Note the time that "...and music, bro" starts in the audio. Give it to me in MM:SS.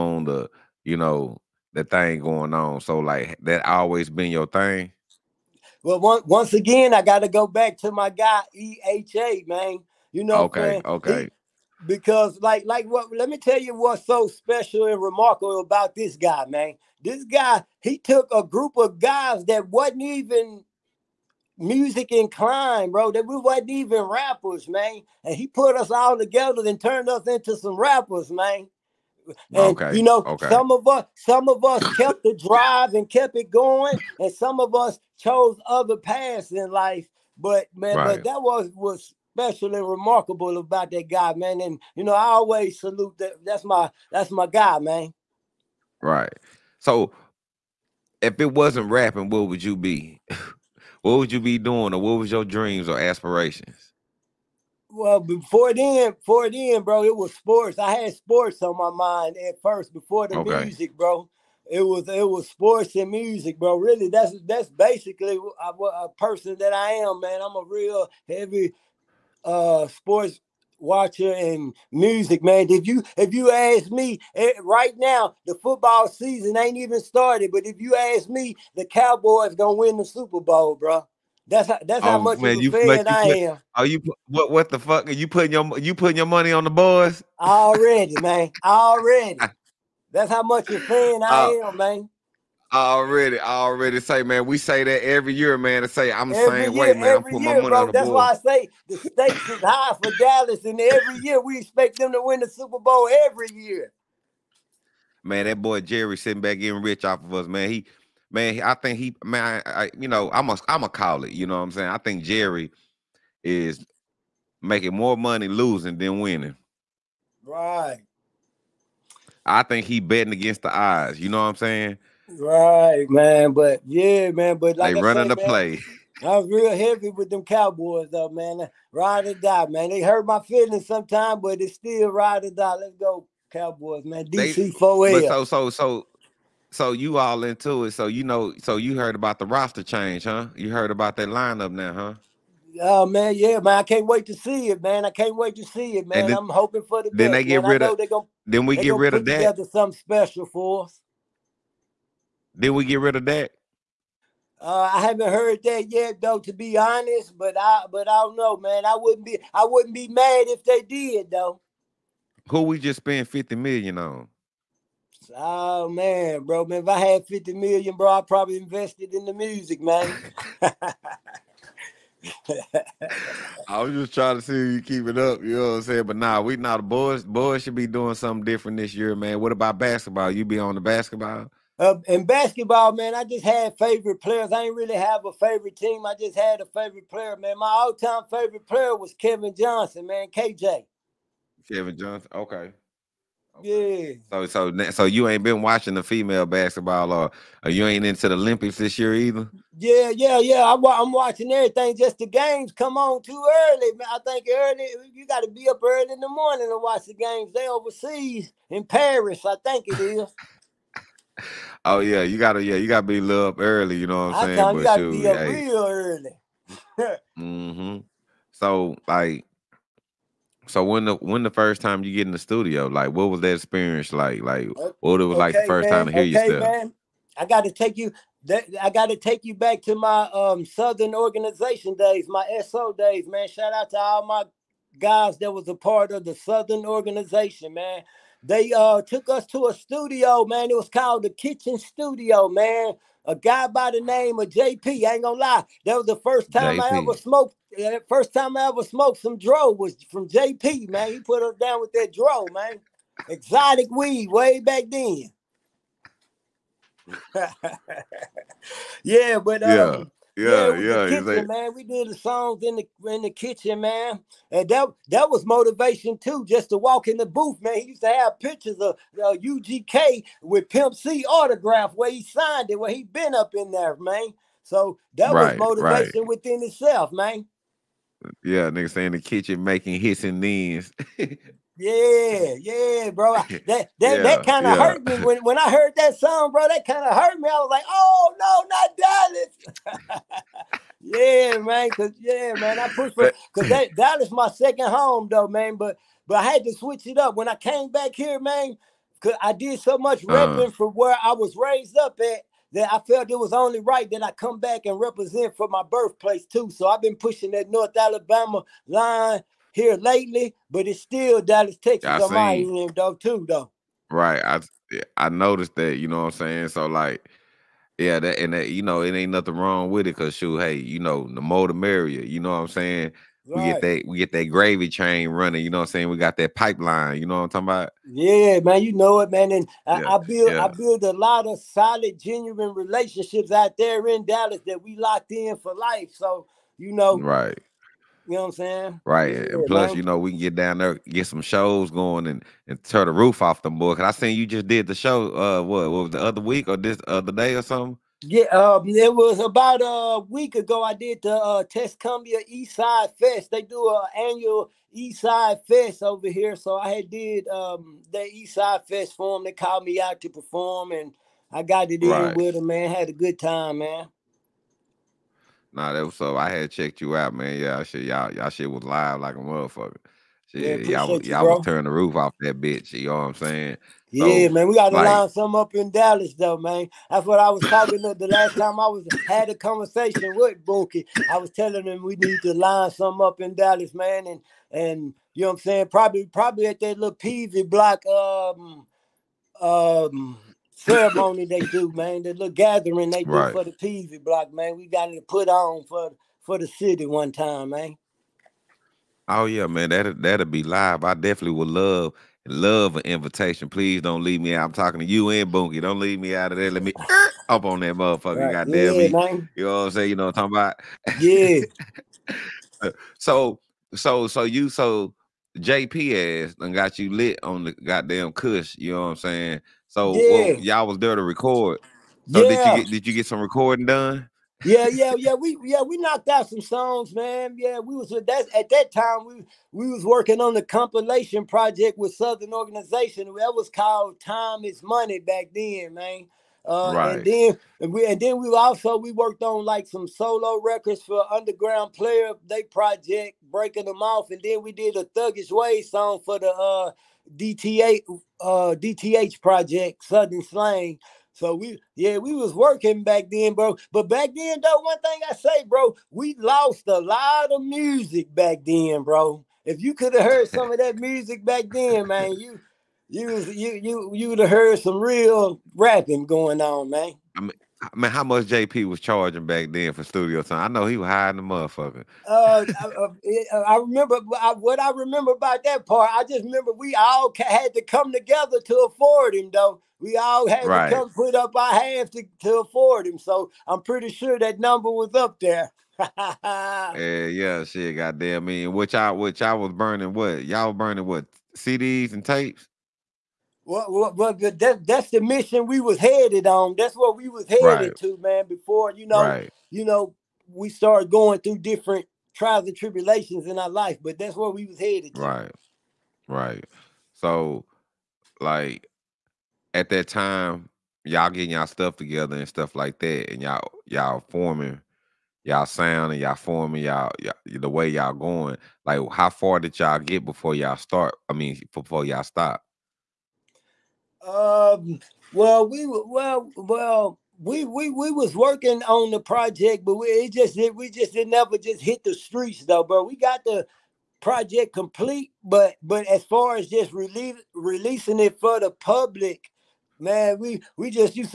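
01:02.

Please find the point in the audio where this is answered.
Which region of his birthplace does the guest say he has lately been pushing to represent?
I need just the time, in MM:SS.
05:07.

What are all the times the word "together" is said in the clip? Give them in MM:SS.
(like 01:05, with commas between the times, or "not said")
00:26, 02:29, 07:58, 08:31.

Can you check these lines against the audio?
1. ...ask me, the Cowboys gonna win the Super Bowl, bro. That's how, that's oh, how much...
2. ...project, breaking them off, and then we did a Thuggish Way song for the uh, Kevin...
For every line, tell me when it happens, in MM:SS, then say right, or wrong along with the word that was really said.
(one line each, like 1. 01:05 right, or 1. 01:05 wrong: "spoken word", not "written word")
1. 01:17 right
2. 07:22 wrong: "DTA", not "Kevin".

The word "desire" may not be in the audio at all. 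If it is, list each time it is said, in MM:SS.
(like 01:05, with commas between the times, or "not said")
not said.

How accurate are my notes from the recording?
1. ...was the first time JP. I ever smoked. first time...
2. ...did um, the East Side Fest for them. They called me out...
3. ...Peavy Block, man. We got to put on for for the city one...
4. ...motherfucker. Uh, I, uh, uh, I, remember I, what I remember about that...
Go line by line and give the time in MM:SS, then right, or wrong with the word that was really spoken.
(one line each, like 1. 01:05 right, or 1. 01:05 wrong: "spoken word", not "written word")
1. 04:05 right
2. 05:57 right
3. 06:33 right
4. 07:51 right.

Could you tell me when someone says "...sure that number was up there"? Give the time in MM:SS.
08:04.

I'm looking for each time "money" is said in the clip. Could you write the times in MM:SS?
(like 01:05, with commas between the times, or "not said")
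01:26, 01:37, 01:55, 07:14.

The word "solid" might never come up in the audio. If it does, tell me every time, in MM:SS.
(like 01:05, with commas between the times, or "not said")
05:31.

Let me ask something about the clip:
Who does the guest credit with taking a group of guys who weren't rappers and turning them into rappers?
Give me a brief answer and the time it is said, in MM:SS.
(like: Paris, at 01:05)
EHA, at 00:08.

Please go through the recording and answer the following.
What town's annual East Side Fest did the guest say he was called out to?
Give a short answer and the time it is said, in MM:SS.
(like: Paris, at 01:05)
Tuscumbia, at 05:51.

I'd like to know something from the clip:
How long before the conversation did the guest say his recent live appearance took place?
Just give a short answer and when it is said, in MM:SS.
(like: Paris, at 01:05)
About a week ago, at 05:49.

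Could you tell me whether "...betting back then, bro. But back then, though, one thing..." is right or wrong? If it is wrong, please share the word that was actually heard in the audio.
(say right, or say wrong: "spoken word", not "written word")
wrong: "working", not "betting".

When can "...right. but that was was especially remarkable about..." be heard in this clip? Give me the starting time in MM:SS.
00:37.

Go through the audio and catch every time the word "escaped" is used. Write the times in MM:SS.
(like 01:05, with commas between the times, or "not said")
not said.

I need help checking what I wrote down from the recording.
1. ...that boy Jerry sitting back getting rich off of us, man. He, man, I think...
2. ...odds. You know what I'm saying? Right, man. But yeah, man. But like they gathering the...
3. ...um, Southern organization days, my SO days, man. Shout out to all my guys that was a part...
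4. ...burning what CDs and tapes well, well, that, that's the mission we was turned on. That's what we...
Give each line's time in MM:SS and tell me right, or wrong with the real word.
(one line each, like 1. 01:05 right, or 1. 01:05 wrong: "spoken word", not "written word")
1. 01:45 right
2. 02:00 wrong: "running", not "gathering"
3. 03:50 right
4. 08:10 wrong: "headed", not "turned".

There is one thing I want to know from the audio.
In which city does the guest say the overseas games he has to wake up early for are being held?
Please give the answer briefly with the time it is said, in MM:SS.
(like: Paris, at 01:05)
Paris, at 03:28.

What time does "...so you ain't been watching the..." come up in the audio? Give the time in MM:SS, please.
03:14.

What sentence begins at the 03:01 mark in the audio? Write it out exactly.
Uh, in basketball, man, I just had favorite players.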